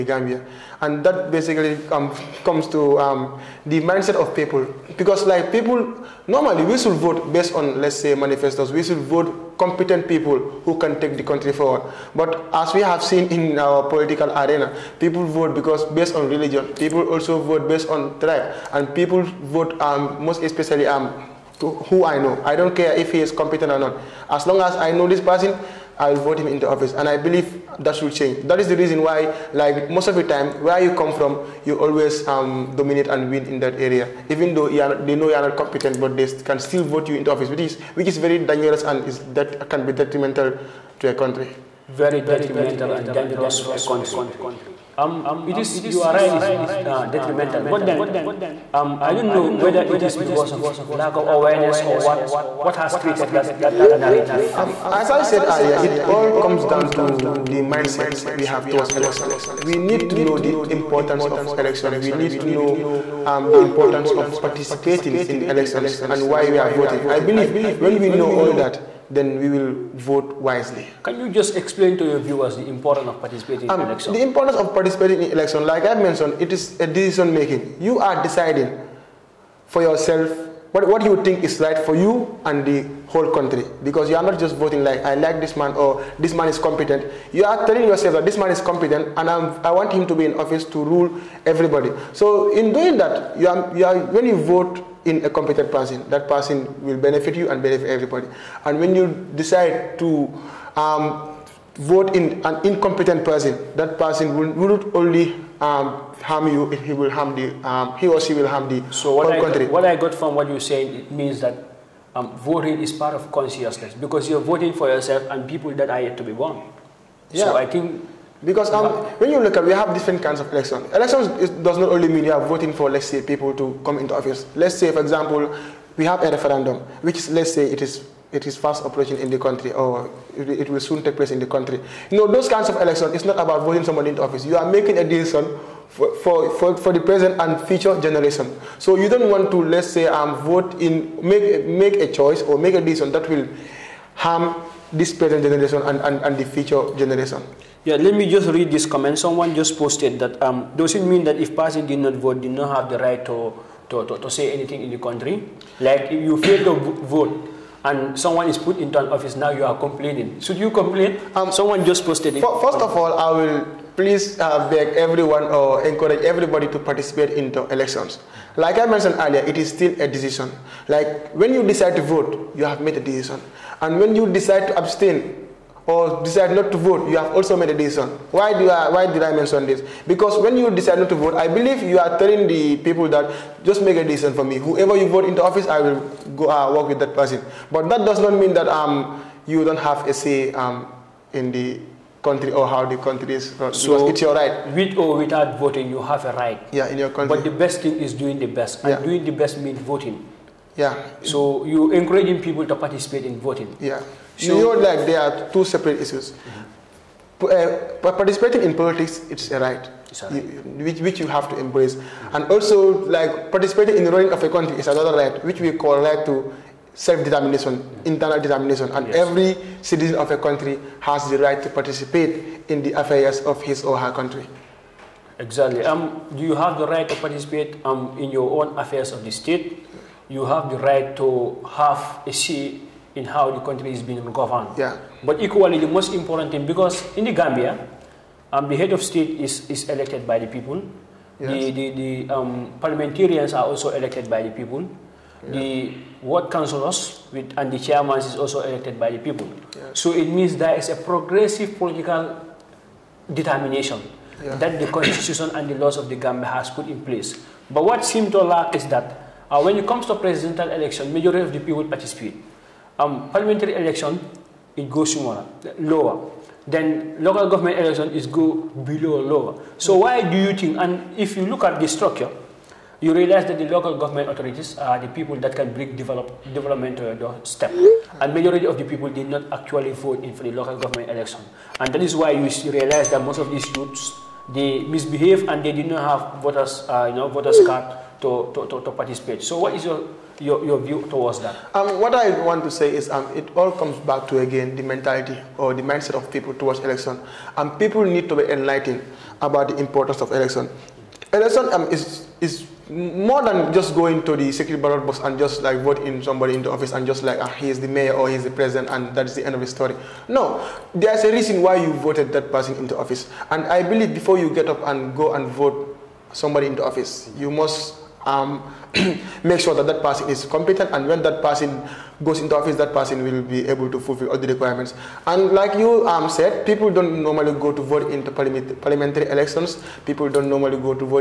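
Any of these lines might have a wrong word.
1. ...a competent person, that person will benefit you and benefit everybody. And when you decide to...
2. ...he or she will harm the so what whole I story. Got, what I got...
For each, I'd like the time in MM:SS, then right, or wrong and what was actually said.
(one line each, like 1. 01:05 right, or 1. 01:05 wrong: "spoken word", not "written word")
1. 01:35 right
2. 01:47 wrong: "country", not "story".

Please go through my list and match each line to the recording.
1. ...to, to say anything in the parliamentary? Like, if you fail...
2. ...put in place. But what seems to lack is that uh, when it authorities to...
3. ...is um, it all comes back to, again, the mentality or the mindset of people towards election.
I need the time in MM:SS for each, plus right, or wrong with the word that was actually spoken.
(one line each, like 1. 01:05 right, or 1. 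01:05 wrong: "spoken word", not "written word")
1. 02:34 wrong: "country", not "parliamentary"
2. 04:16 wrong: "comes", not "authorities"
3. 04:52 right.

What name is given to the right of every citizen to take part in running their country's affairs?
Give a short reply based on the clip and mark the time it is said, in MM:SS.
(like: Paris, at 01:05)
right to self-determination, at 03:35.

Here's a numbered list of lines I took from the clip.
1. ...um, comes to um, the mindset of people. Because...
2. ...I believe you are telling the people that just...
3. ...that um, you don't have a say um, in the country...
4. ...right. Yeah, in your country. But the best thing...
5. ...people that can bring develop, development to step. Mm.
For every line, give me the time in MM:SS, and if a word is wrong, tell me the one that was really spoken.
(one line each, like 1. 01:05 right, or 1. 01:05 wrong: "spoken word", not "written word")
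1. 00:01 right
2. 03:01 right
3. 03:08 right
4. 03:16 right
5. 04:35 right.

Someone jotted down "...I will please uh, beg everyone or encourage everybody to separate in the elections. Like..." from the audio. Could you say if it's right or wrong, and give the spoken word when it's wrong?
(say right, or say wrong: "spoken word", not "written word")
wrong: "participate", not "separate".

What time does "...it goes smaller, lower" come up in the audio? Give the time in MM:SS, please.
04:24.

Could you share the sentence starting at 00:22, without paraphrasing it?
I don't care if he is competent or not.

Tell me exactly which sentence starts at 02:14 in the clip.
You are making a decision for, for, for the present and future generation.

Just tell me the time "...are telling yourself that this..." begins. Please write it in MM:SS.
01:27.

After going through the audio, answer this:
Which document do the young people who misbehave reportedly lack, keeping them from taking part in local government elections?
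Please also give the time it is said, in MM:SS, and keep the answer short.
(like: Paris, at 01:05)
voters card, at 04:47.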